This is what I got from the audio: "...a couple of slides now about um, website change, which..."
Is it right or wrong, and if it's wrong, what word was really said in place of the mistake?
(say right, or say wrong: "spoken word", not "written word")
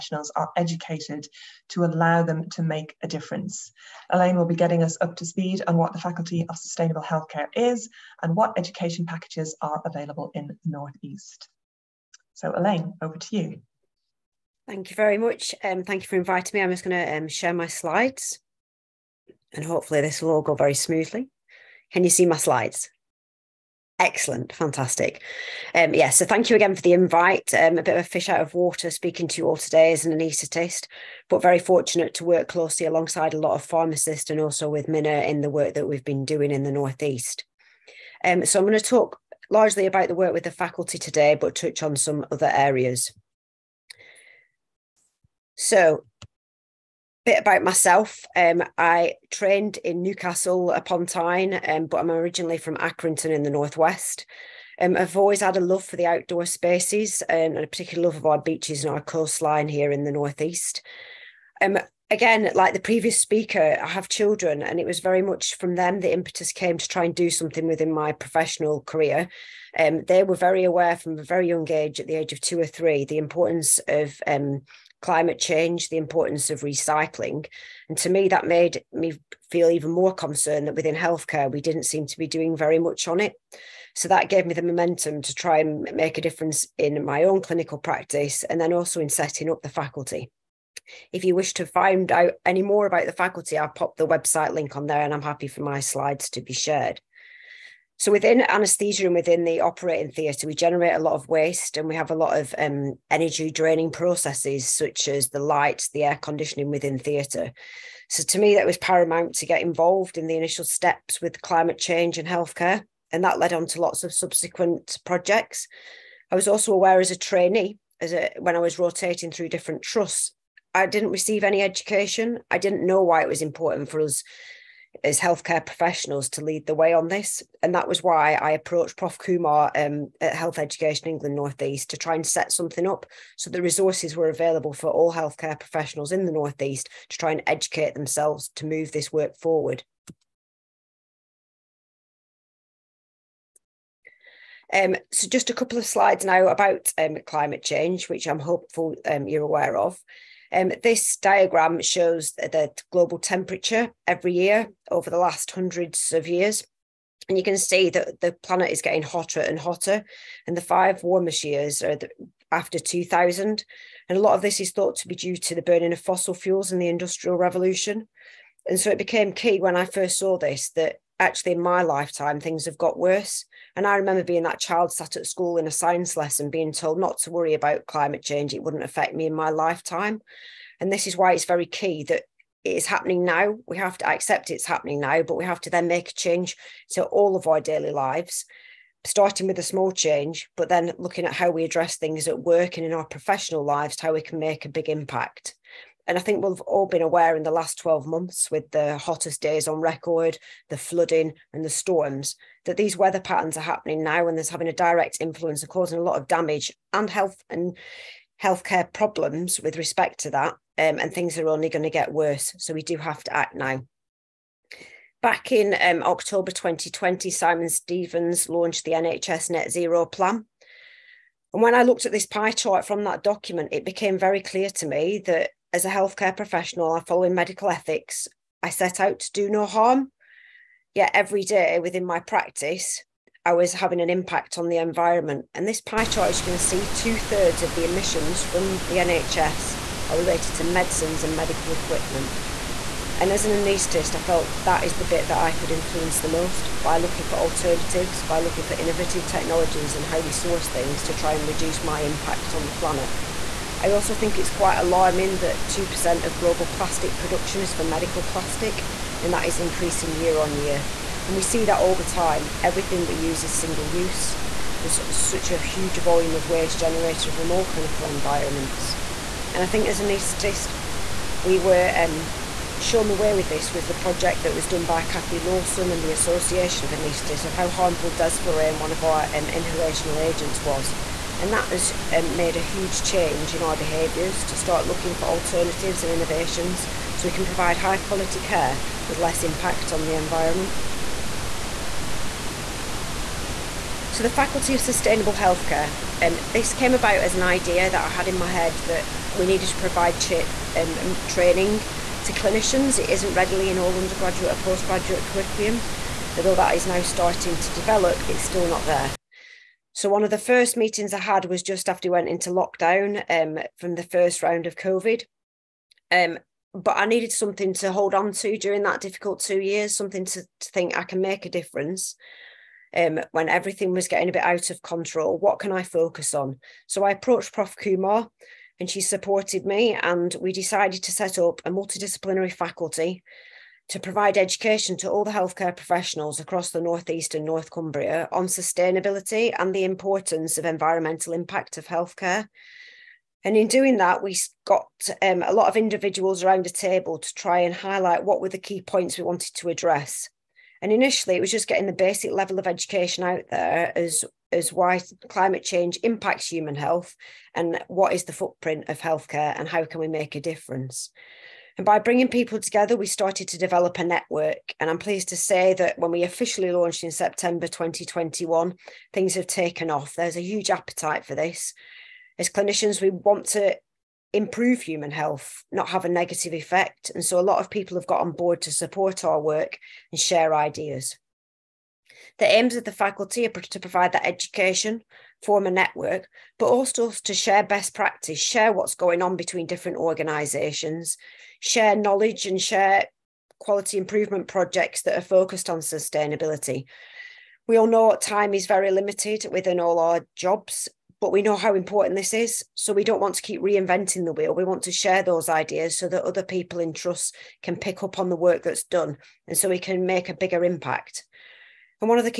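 wrong: "climate", not "website".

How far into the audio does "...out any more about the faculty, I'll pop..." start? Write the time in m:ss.
1:32.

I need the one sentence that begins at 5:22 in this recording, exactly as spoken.
Um, when everything was getting a bit out of control, what can I focus on?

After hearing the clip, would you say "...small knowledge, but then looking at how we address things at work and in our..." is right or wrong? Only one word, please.
wrong.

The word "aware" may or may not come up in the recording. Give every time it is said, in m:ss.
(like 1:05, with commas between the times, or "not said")
1:10, 1:56, 2:29, 3:17.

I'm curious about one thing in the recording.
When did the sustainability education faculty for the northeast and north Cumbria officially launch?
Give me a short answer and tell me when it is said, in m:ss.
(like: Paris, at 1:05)
September 2021, at 6:07.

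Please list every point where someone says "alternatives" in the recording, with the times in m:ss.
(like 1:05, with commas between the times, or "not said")
4:07, 4:45.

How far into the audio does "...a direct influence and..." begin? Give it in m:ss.
3:24.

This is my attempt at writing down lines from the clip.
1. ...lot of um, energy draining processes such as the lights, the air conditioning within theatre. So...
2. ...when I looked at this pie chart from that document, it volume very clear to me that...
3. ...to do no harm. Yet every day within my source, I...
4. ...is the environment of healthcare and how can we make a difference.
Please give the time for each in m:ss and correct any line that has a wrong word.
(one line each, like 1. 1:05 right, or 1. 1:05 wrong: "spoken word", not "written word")
1. 1:42 right
2. 3:41 wrong: "became", not "volume"
3. 3:49 wrong: "practice", not "source"
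4. 5:58 wrong: "footprint", not "environment".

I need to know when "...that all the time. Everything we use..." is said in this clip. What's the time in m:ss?
4:21.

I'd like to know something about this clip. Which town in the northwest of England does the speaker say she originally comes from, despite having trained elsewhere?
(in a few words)
Accrington.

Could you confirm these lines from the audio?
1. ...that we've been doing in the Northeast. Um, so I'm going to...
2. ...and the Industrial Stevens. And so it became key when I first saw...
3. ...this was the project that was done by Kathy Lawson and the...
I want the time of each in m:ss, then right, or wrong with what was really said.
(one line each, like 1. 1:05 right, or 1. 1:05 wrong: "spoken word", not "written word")
1. 0:35 right
2. 2:46 wrong: "Revolution", not "Stevens"
3. 4:33 right.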